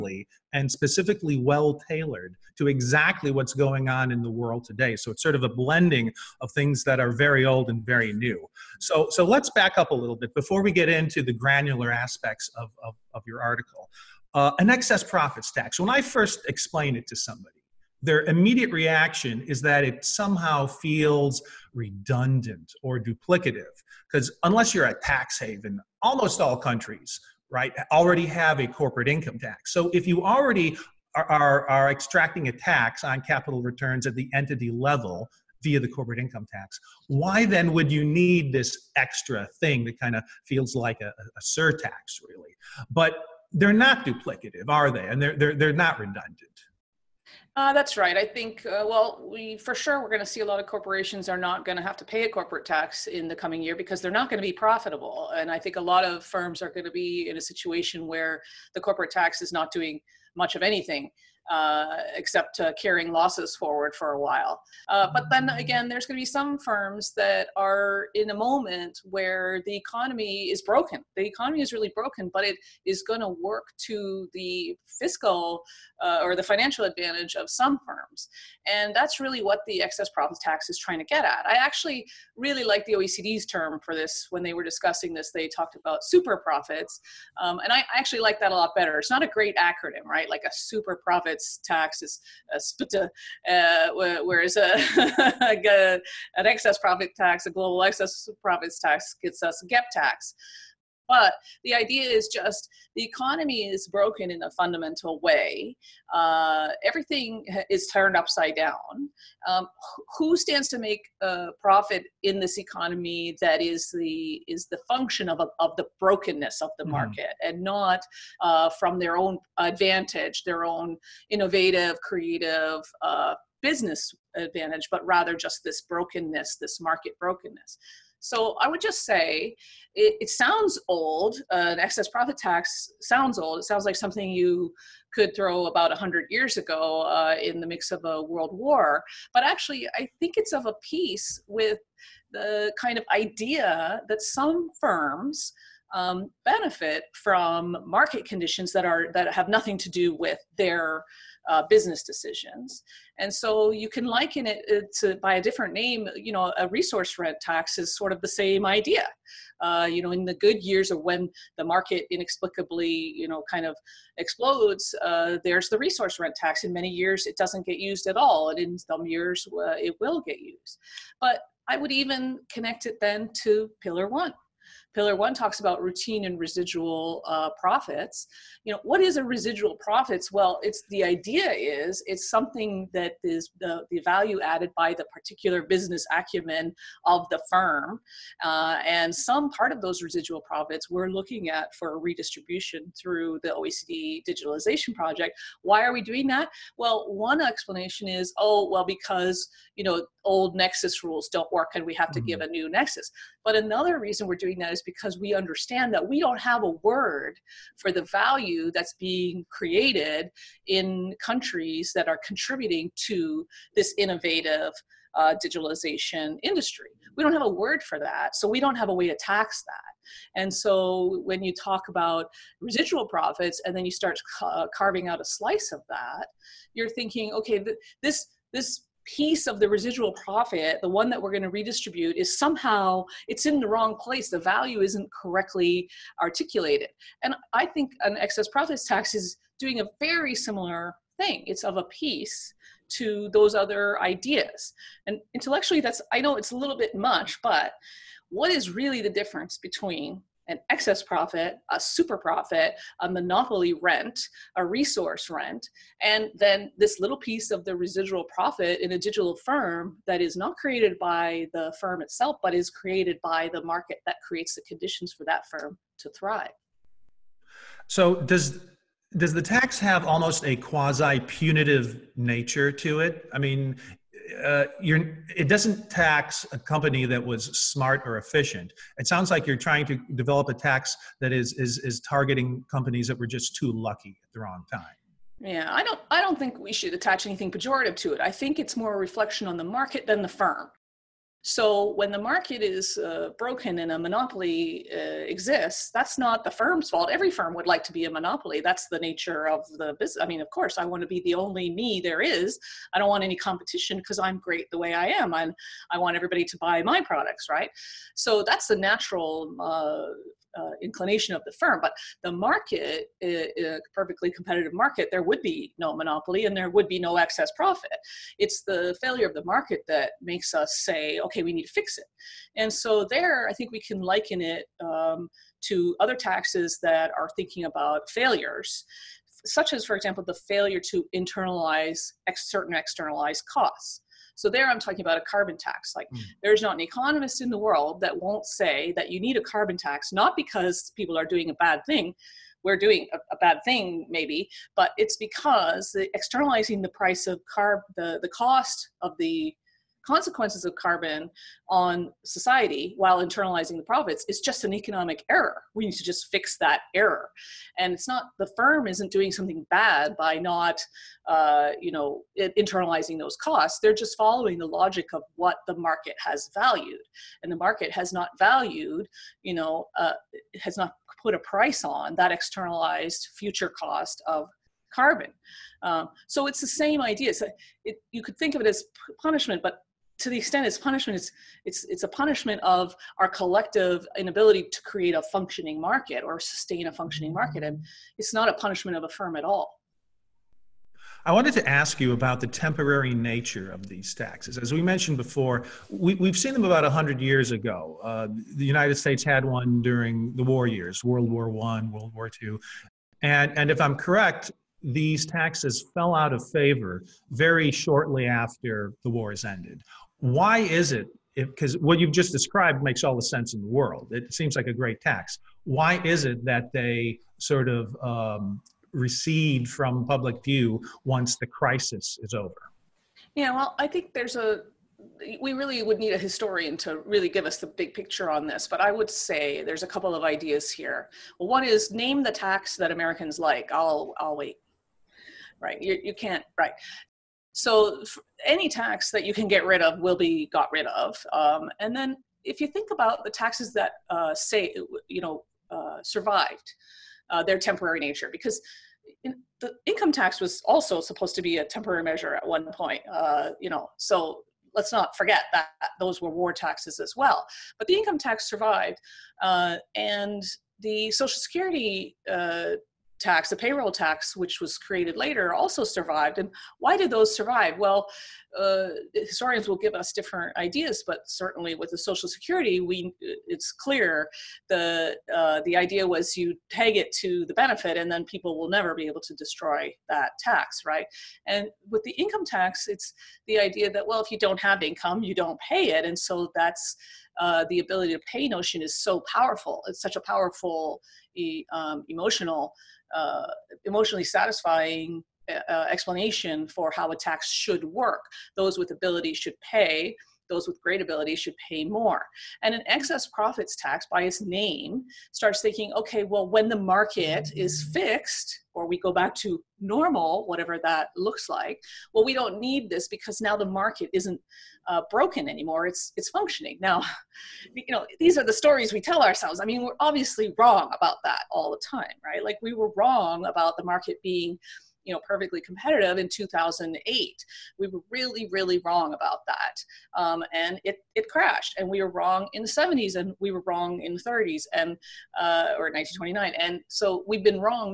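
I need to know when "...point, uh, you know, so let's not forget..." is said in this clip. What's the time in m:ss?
7:32.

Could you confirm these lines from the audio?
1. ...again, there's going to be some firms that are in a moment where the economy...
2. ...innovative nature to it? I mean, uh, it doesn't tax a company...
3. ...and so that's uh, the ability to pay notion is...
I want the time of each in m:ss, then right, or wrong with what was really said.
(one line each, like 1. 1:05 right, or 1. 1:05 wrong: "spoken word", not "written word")
1. 1:05 right
2. 4:31 wrong: "punitive", not "innovative"
3. 8:06 right.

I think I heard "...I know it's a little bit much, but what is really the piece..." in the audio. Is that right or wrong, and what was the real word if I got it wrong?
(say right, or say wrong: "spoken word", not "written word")
wrong: "difference", not "piece".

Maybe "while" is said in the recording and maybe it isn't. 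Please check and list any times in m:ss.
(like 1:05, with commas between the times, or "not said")
1:04, 5:52.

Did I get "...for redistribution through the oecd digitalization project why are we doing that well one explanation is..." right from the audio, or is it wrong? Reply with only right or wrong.
right.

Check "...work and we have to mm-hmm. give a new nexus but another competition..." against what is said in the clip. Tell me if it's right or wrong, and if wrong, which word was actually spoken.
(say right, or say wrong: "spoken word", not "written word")
wrong: "reason", not "competition".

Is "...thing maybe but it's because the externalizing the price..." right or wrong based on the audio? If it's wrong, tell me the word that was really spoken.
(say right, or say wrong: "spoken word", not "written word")
right.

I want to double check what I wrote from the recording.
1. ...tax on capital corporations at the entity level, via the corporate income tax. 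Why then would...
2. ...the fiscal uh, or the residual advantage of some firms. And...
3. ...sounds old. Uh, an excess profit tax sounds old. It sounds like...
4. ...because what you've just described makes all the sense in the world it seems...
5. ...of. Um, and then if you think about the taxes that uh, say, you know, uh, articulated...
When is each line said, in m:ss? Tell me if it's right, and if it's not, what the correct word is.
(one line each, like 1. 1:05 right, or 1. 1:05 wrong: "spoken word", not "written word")
1. 0:32 wrong: "returns", not "corporations"
2. 1:14 wrong: "financial", not "residual"
3. 2:10 right
4. 6:51 right
5. 7:20 wrong: "survived", not "articulated".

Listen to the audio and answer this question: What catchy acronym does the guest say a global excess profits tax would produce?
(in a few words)
gap tax.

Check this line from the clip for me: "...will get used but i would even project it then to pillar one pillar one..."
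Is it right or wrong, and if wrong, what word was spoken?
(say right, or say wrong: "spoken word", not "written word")
wrong: "connect", not "project".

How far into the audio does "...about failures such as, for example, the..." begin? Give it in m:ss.
5:27.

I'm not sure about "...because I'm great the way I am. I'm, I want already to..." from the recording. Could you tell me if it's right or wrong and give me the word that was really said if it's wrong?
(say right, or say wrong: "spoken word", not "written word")
wrong: "everybody", not "already".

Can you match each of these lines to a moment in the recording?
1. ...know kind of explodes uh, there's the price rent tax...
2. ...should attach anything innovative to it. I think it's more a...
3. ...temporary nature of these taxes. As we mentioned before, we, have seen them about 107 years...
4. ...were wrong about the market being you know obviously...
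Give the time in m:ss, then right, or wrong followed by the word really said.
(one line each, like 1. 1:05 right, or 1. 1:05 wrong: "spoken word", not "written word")
1. 2:43 wrong: "resource", not "price"
2. 4:46 wrong: "pejorative", not "innovative"
3. 6:32 wrong: "100", not "107"
4. 8:42 wrong: "perfectly", not "obviously".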